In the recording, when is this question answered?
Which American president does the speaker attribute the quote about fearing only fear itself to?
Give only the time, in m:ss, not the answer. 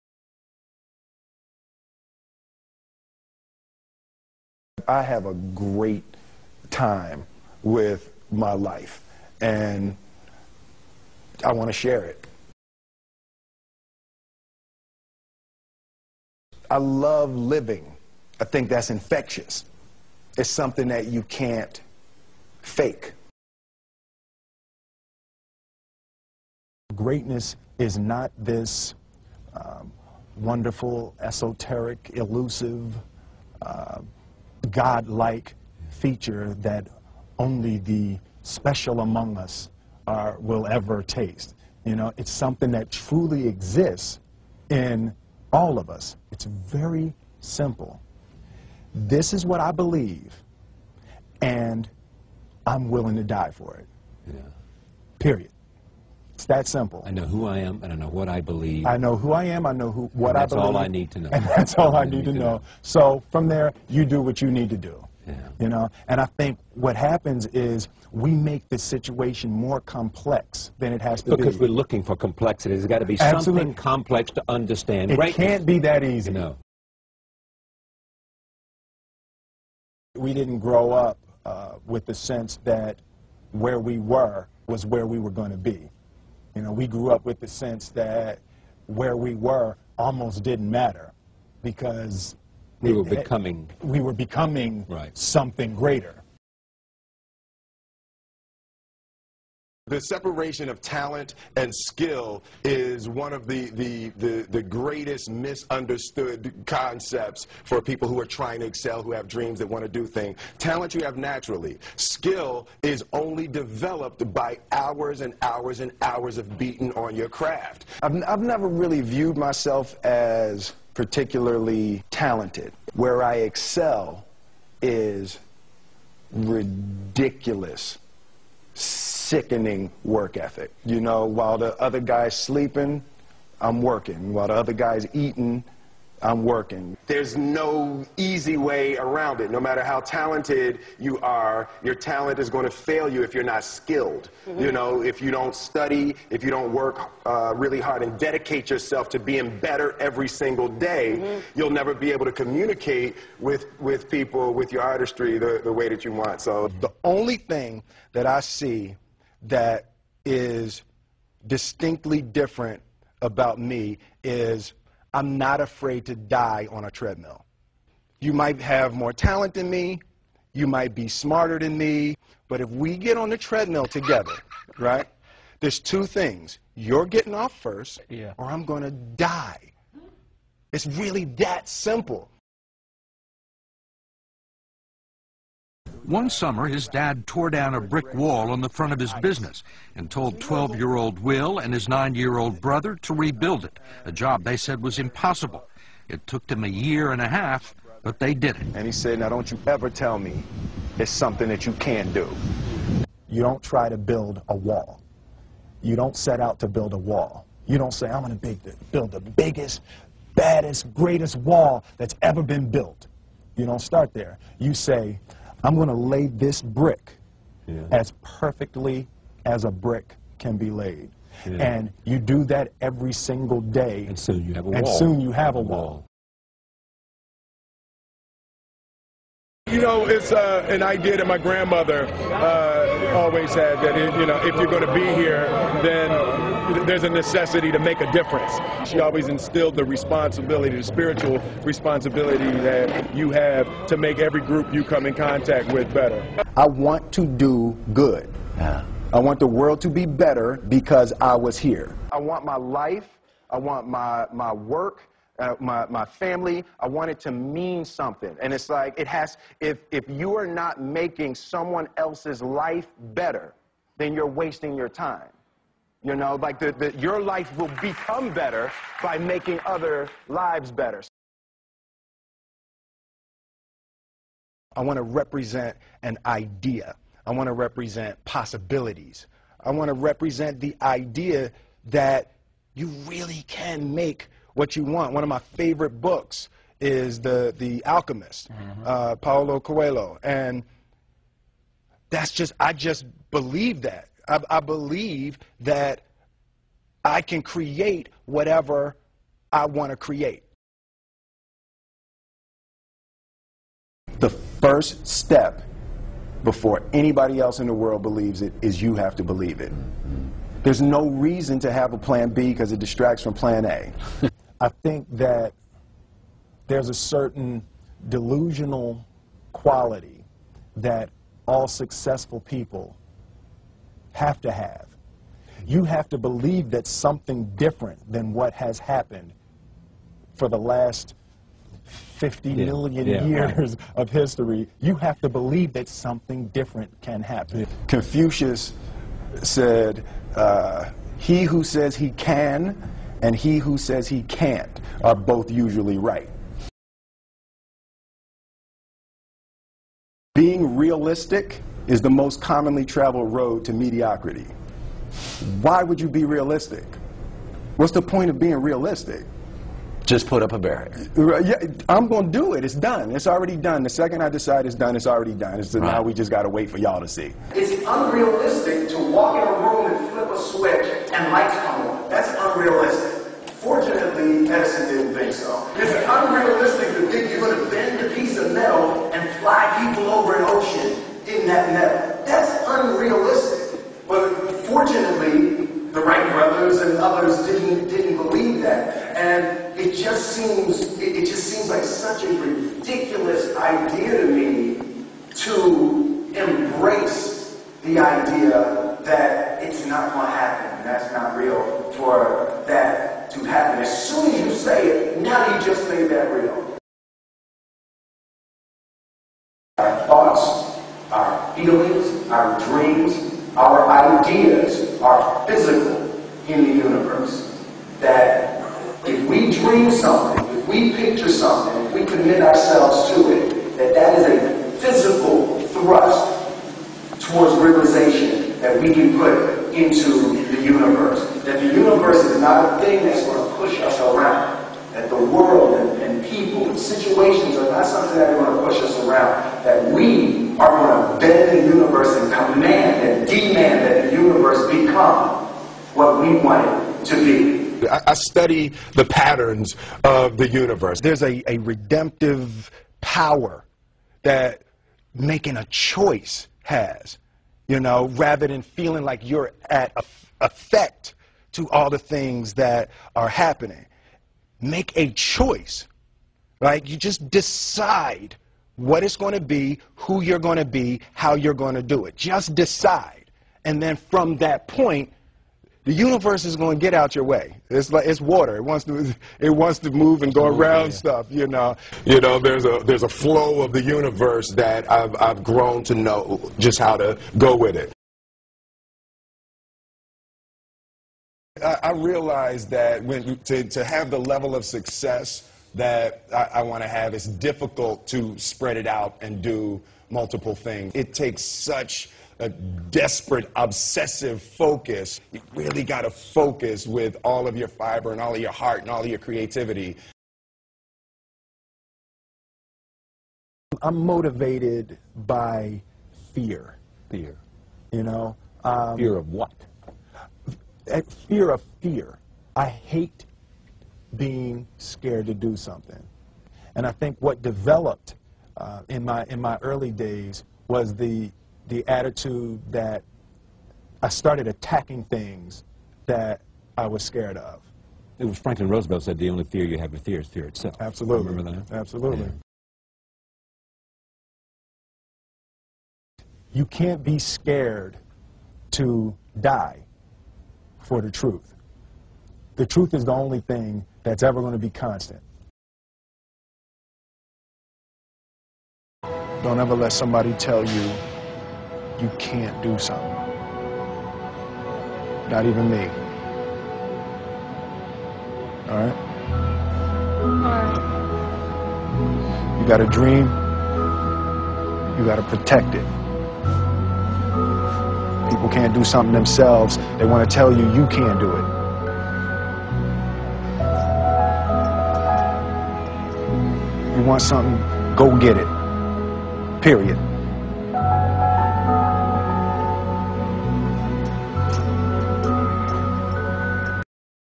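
8:58.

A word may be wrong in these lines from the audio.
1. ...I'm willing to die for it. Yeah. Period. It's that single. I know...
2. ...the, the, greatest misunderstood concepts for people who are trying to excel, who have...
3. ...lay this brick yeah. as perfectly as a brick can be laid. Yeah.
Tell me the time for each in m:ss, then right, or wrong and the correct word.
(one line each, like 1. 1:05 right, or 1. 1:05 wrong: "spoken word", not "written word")
1. 0:52 wrong: "simple", not "single"
2. 1:44 right
3. 3:35 right.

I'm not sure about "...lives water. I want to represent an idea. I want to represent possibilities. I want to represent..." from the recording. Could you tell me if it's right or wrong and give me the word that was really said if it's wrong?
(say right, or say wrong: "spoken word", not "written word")
wrong: "better", not "water".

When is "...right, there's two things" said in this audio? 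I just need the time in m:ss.
2:54.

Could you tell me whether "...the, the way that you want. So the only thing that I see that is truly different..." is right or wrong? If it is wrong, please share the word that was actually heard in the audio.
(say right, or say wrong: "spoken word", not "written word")
wrong: "distinctly", not "truly".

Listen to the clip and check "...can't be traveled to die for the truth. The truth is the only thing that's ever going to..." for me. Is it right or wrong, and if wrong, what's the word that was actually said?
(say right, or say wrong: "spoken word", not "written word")
wrong: "scared", not "traveled".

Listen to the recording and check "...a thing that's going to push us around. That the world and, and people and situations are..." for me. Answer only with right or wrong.
right.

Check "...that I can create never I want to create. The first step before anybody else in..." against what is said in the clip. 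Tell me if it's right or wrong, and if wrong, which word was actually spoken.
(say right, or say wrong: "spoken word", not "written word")
wrong: "whatever", not "never".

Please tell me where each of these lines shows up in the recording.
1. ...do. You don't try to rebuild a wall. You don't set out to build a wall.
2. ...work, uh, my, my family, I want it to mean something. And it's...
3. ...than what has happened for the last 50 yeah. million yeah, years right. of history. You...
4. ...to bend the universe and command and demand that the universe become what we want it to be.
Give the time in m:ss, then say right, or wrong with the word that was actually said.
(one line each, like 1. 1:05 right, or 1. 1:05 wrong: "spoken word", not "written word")
1. 3:22 wrong: "build", not "rebuild"
2. 4:14 right
3. 5:28 right
4. 7:21 right.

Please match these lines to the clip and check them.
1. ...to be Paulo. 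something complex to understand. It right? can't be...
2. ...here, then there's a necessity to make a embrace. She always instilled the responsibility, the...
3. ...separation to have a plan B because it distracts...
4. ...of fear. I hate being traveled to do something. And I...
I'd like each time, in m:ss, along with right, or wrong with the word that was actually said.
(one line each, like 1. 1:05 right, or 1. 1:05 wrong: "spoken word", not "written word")
1. 1:12 wrong: "Absolutely", not "Paulo"
2. 3:55 wrong: "difference", not "embrace"
3. 5:11 wrong: "reason", not "separation"
4. 8:41 wrong: "scared", not "traveled".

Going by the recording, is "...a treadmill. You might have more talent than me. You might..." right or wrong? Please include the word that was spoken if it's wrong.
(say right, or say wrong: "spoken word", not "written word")
right.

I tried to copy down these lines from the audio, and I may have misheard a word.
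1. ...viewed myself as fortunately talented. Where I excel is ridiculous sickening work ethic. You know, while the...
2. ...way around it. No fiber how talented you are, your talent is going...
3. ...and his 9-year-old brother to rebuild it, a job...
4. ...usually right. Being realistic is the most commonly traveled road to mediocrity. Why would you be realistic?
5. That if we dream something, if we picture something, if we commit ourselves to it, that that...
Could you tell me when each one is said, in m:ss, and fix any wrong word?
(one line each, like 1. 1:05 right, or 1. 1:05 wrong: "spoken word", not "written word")
1. 1:59 wrong: "particularly", not "fortunately"
2. 2:18 wrong: "matter", not "fiber"
3. 3:11 right
4. 5:45 right
5. 6:57 right.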